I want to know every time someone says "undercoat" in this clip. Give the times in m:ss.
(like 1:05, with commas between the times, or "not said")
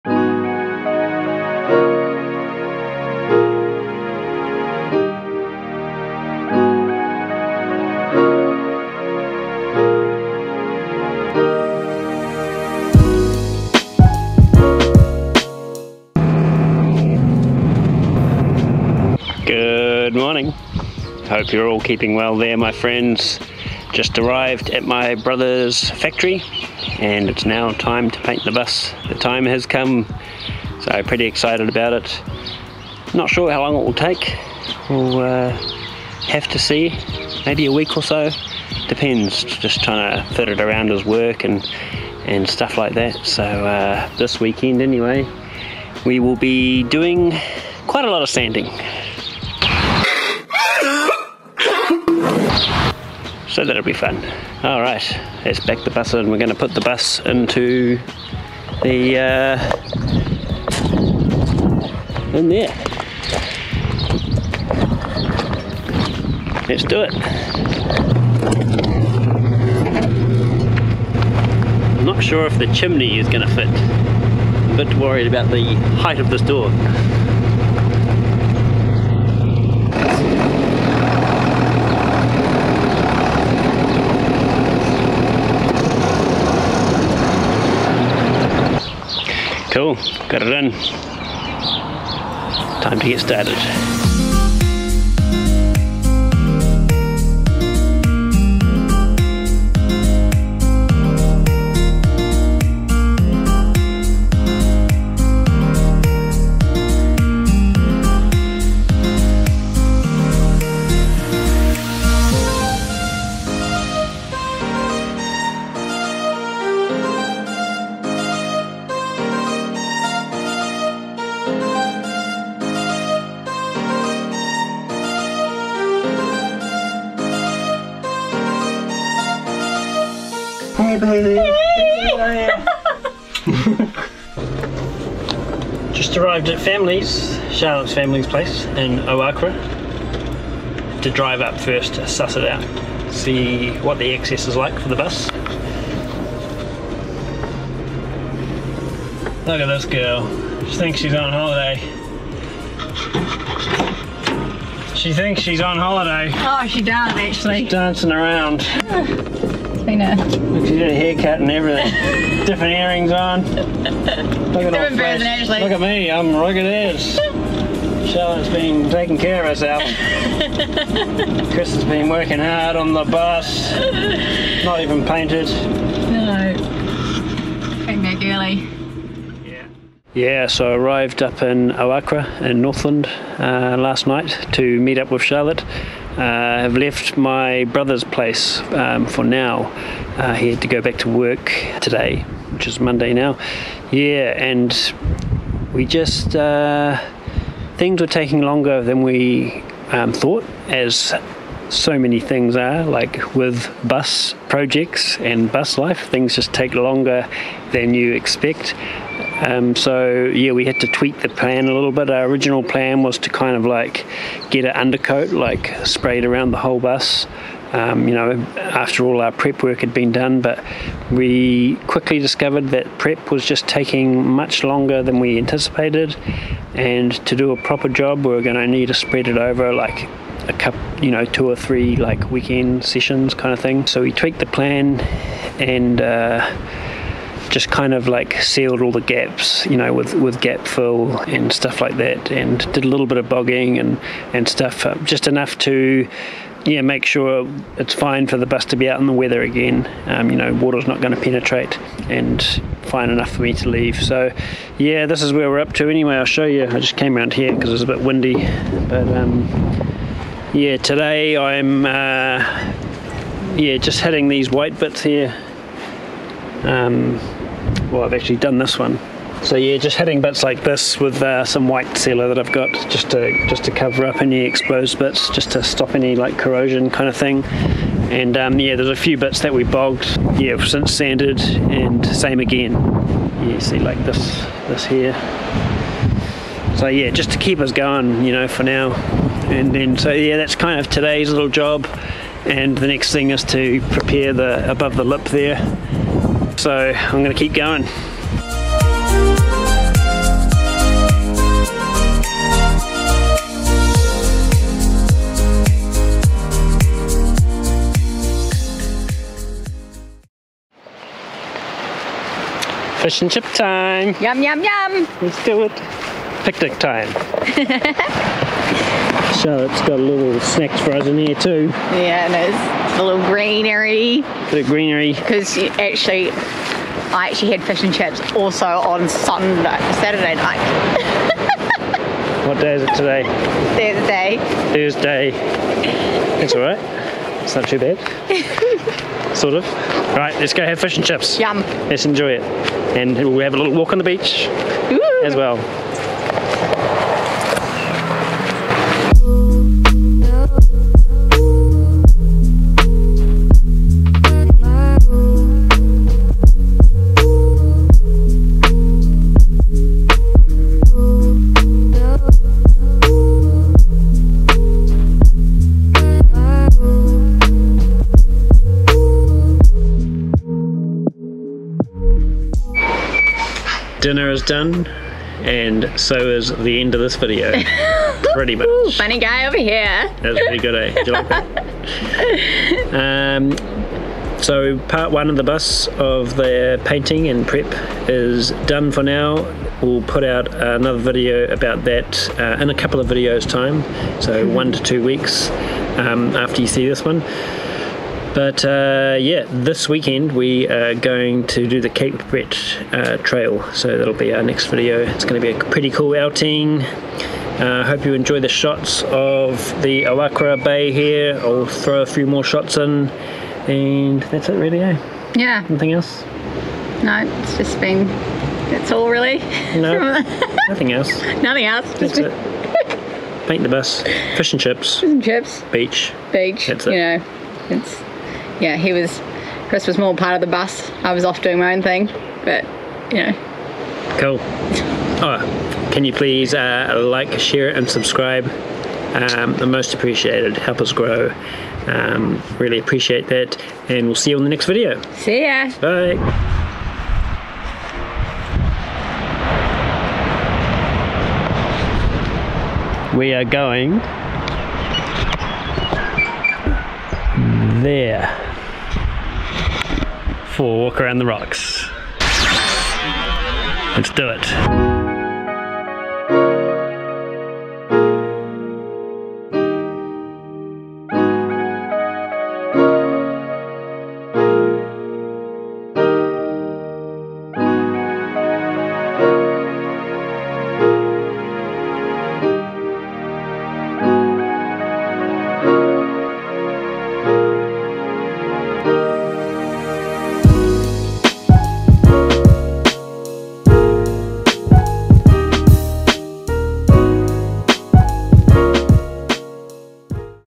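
3:34.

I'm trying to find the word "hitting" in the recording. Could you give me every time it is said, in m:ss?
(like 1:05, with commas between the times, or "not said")
4:24, 4:29.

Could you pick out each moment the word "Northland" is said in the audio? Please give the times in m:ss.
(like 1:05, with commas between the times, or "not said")
3:02.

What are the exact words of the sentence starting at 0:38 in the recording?
Depends, just trying to fit it around his work and, and stuff like that.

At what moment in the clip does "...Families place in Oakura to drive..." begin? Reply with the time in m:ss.
2:17.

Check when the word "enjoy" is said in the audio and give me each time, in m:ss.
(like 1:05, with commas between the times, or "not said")
5:42, 6:48.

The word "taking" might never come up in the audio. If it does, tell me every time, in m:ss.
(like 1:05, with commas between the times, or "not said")
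2:48, 3:18, 3:43.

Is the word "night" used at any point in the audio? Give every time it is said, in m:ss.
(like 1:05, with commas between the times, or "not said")
3:04, 5:30.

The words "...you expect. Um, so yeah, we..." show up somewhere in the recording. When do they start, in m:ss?
3:27.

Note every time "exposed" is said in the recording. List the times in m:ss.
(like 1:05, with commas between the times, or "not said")
4:34.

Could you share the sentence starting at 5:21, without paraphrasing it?
Yeah, and it's a little greenery.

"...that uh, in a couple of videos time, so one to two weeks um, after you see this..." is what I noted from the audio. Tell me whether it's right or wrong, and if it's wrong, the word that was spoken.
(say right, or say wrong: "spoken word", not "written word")
right.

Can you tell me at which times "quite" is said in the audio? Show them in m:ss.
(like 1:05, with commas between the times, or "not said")
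0:47.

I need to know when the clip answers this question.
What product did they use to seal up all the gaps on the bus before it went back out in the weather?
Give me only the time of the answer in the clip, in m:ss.
4:00.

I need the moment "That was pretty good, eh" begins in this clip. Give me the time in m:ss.
6:20.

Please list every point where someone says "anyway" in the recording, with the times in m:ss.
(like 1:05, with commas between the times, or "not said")
0:44, 4:15.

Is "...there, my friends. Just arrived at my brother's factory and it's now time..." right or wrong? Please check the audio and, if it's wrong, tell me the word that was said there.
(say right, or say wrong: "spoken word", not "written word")
right.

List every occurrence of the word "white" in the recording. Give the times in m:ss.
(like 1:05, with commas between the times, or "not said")
4:24, 4:31.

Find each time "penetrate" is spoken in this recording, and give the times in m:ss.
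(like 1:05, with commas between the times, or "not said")
4:11.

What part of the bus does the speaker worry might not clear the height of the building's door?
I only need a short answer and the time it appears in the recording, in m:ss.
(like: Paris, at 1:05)
the chimney, at 1:12.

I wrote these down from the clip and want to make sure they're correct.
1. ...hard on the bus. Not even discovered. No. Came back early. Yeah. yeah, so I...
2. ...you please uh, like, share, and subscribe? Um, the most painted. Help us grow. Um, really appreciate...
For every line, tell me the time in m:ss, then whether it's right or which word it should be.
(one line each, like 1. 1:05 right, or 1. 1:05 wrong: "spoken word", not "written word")
1. 2:52 wrong: "painted", not "discovered"
2. 7:16 wrong: "appreciated", not "painted".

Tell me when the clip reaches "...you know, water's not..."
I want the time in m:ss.
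4:10.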